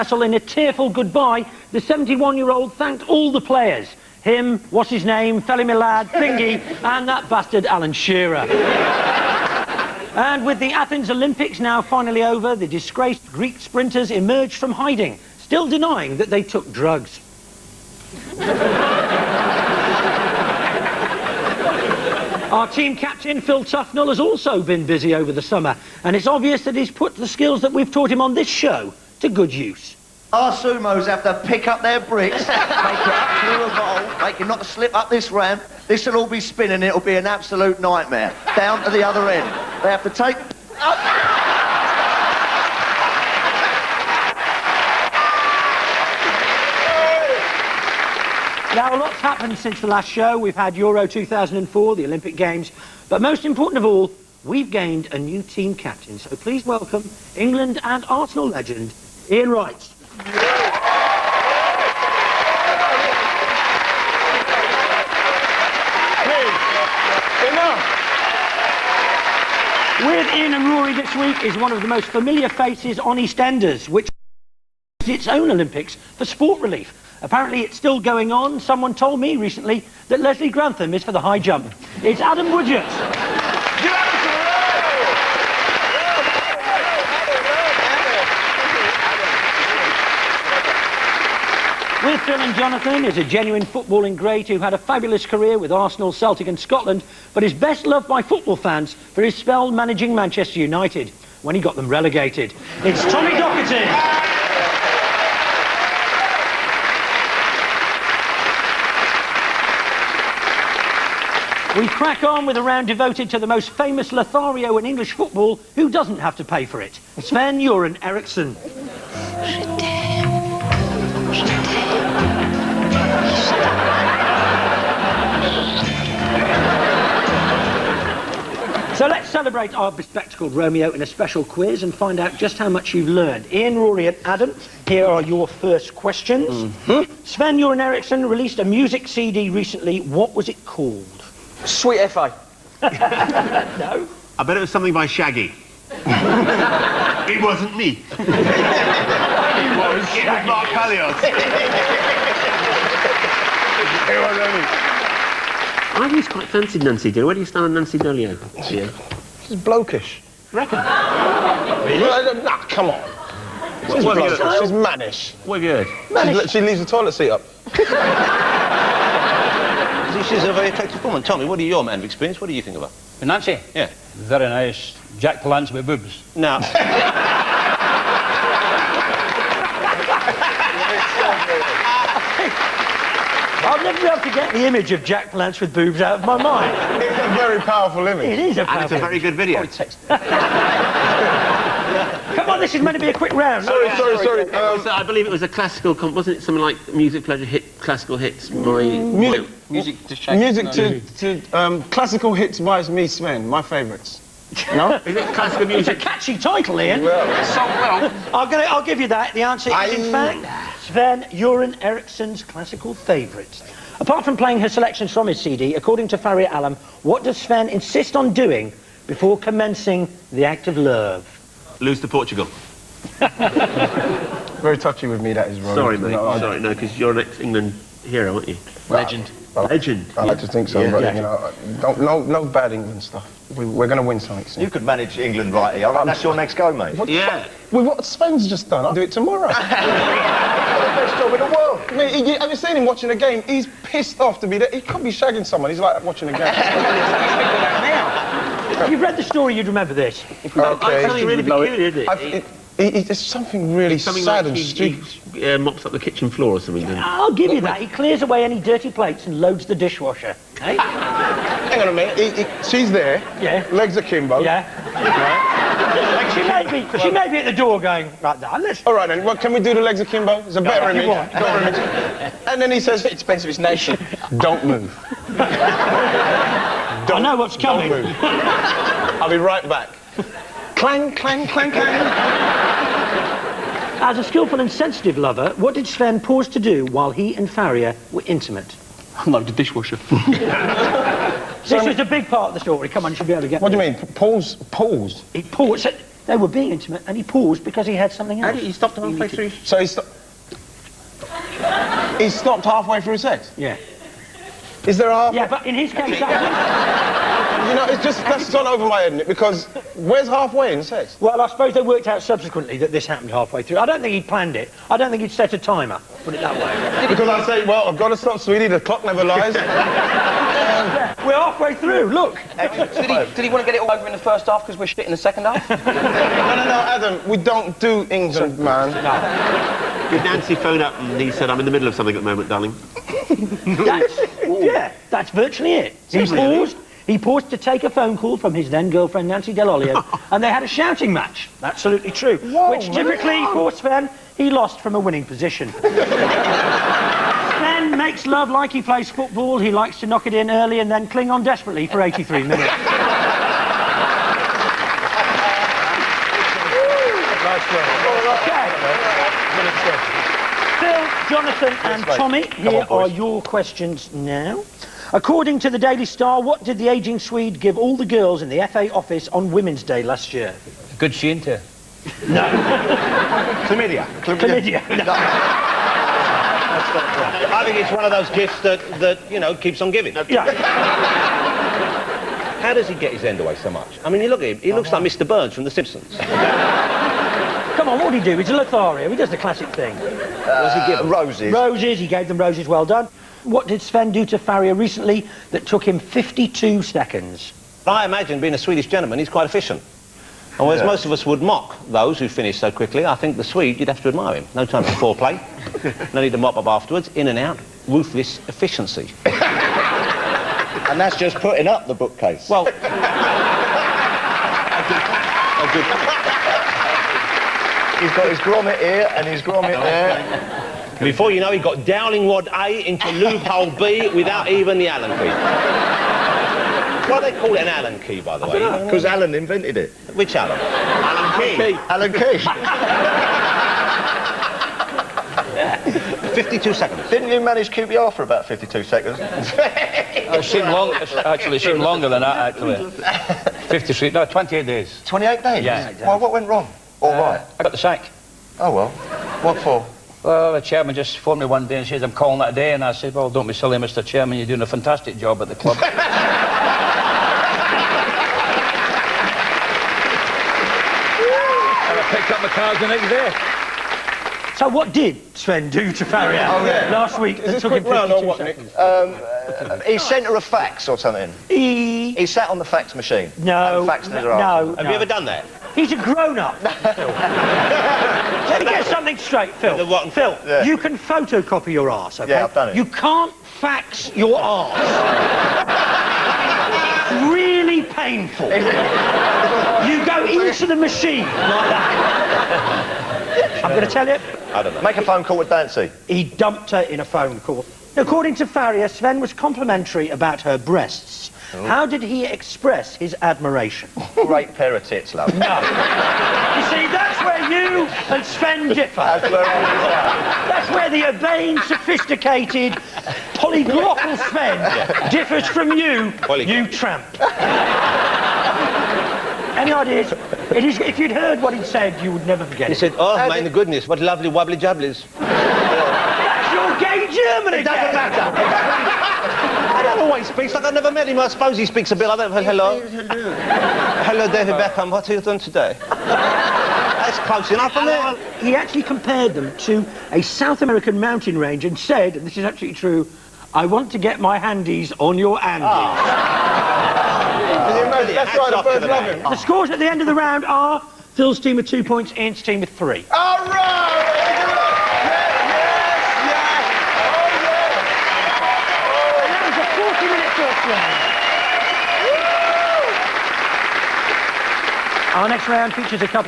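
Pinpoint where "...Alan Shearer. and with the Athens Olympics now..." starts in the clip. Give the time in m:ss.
0:07.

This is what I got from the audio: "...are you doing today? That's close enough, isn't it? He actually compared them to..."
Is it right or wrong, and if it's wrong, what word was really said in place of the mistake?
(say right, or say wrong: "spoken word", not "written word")
right.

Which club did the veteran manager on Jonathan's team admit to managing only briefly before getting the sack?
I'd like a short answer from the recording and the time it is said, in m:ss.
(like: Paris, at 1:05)
QPR, at 7:17.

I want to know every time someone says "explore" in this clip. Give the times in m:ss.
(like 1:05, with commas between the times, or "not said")
not said.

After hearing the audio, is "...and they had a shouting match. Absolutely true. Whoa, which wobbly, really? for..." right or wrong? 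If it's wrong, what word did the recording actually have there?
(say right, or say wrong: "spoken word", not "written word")
wrong: "typically", not "wobbly".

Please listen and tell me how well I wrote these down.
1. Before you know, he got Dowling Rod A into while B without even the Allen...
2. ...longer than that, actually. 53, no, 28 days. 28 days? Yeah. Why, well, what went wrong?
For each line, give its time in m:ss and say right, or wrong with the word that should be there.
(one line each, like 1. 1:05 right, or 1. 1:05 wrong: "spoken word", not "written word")
1. 7:00 wrong: "loophole", not "while"
2. 7:21 right.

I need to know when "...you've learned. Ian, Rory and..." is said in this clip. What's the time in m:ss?
2:12.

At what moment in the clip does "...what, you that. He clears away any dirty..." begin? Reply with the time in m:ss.
4:17.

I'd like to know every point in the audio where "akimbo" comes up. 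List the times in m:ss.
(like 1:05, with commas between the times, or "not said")
4:23, 4:30.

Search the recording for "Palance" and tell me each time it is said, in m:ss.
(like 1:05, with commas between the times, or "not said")
2:55, 3:05.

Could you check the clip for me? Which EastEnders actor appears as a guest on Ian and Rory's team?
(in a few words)
Adam Woodyatt.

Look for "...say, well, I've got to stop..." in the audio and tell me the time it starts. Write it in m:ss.
5:17.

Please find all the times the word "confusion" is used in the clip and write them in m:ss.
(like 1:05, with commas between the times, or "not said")
not said.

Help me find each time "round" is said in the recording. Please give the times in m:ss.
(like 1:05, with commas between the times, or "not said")
1:52, 3:13, 9:10, 9:25.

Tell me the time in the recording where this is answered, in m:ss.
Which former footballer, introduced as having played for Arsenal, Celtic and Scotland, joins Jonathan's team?
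1:43.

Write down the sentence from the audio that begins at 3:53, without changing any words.
We, are going to win something soon.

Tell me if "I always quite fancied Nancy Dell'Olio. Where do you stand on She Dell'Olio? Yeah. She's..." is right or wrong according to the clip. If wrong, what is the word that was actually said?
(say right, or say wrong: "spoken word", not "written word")
wrong: "Nancy", not "She".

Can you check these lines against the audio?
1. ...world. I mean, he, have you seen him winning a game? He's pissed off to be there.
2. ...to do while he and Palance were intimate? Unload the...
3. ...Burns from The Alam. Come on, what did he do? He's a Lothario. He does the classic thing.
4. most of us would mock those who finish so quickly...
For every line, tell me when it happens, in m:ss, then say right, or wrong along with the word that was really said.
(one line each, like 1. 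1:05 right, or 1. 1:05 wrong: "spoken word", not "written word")
1. 4:01 wrong: "watching", not "winning"
2. 4:46 wrong: "Faria", not "Palance"
3. 6:25 wrong: "Simpsons", not "Alam"
4. 6:40 right.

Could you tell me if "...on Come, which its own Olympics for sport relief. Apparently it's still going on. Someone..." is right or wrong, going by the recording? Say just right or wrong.
wrong.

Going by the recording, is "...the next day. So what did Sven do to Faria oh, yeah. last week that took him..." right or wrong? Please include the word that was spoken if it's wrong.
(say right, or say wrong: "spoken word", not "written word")
right.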